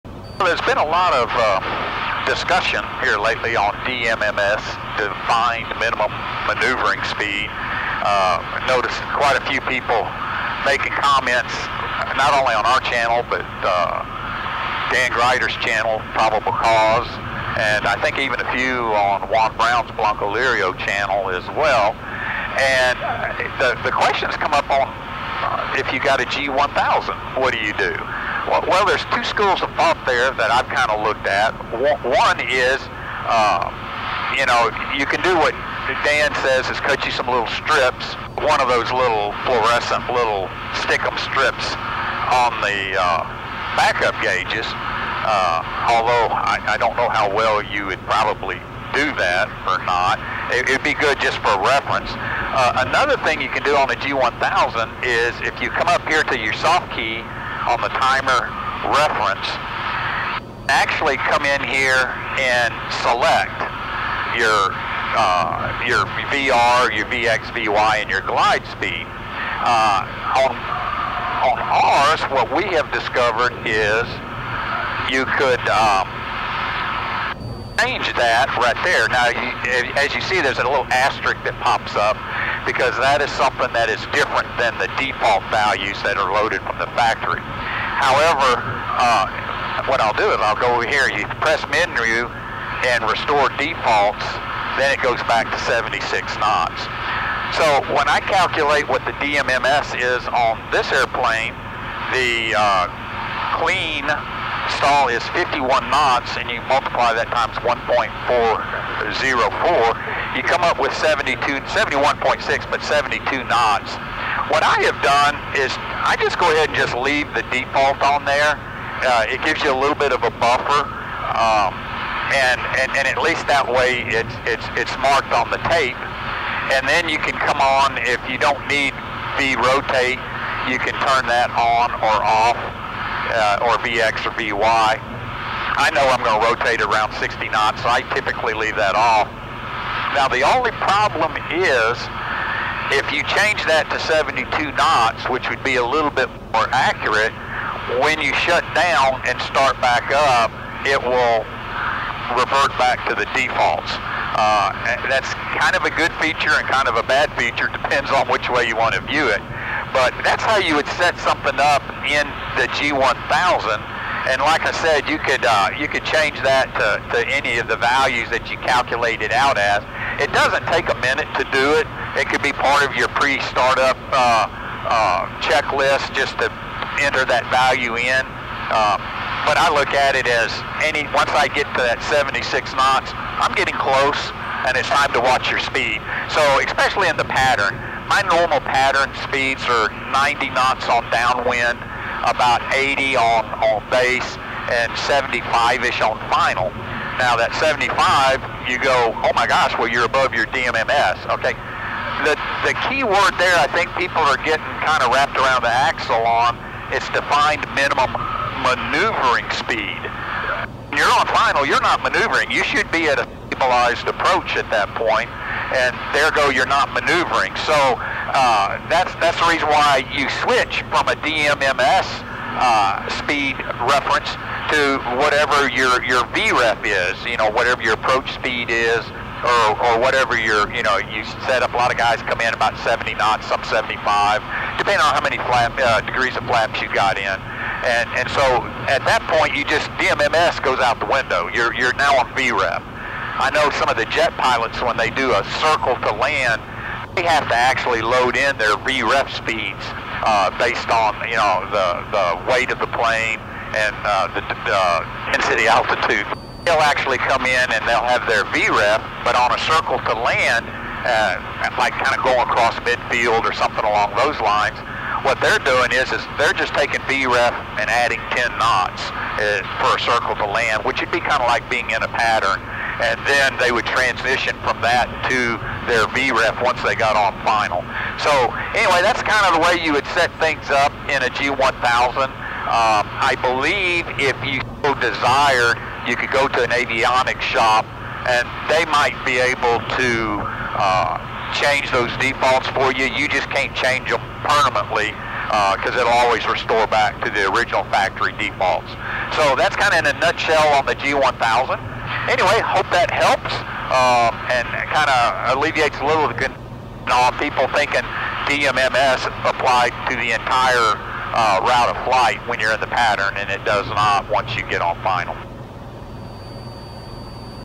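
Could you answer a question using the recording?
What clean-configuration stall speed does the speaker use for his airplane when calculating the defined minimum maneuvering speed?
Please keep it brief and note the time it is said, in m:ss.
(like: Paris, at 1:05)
51 knots, at 1:45.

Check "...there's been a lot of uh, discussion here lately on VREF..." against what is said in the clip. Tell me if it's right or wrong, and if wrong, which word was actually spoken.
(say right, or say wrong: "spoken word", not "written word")
wrong: "DMMS", not "VREF".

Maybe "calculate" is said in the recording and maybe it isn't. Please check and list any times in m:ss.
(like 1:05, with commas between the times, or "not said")
1:38, 2:48.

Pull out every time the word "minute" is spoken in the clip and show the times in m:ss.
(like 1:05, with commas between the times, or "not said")
2:51.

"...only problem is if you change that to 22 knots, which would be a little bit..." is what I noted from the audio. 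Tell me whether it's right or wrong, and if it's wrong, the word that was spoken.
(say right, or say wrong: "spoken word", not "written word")
wrong: "72", not "22".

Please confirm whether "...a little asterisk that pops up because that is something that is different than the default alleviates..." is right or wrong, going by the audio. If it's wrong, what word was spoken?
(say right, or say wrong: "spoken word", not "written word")
wrong: "values", not "alleviates".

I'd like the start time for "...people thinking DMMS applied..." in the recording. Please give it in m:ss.
5:07.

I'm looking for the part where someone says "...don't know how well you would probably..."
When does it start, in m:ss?
0:46.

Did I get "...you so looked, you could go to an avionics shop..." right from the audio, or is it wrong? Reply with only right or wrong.
wrong.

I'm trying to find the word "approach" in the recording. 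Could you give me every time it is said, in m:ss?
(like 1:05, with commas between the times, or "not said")
3:34, 3:47.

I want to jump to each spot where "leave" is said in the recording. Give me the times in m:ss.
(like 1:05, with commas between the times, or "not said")
1:56, 2:18.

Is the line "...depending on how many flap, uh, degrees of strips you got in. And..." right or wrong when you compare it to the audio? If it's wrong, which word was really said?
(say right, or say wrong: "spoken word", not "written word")
wrong: "flaps", not "strips".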